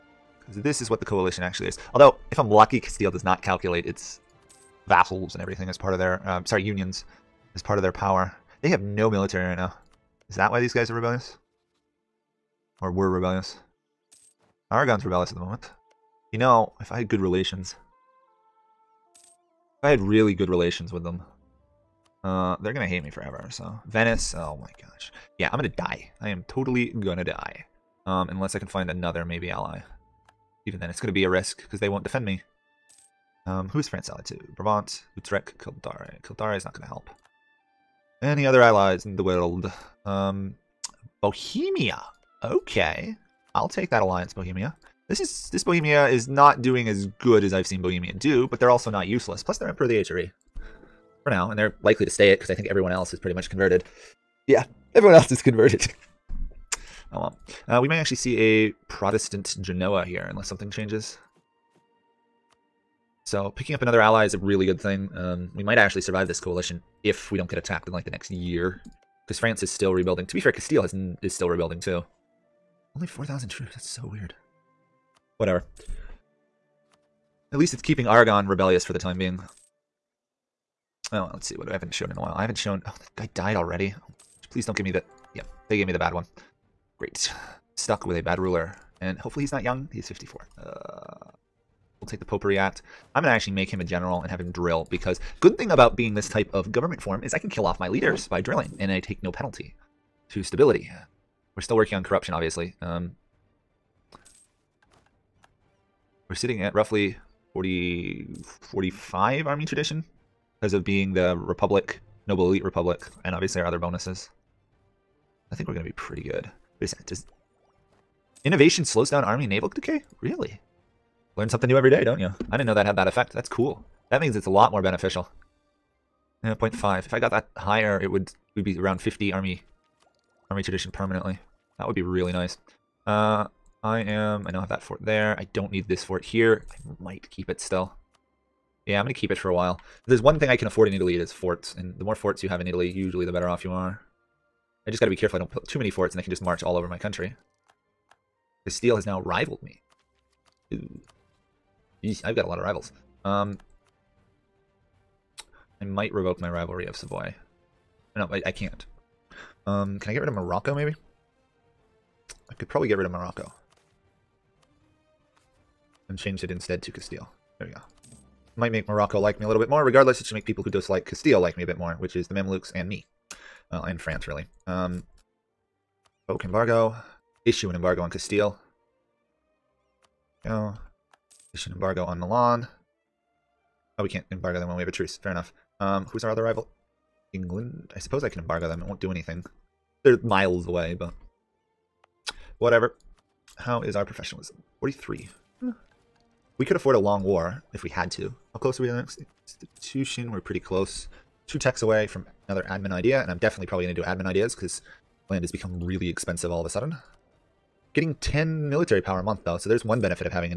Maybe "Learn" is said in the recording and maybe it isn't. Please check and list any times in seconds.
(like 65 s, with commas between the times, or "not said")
121 s.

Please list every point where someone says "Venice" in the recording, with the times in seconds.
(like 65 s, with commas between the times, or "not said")
23 s.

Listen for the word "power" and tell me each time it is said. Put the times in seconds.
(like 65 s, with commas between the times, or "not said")
7 s, 209 s.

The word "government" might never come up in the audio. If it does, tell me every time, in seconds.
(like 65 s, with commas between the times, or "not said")
96 s.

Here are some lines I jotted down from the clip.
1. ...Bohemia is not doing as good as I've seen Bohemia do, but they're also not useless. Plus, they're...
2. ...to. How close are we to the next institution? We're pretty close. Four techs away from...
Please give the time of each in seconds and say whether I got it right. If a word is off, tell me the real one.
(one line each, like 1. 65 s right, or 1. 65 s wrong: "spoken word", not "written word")
1. 45 s right
2. 198 s wrong: "Two", not "Four".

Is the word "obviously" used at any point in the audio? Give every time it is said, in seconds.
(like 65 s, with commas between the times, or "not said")
102 s, 113 s.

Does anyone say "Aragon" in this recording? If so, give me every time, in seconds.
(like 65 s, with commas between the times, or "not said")
14 s, 78 s.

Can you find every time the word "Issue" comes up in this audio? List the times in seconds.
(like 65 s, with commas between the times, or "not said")
177 s, 181 s.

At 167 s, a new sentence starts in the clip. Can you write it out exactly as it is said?
There we go might make Morocco like me a little bit more.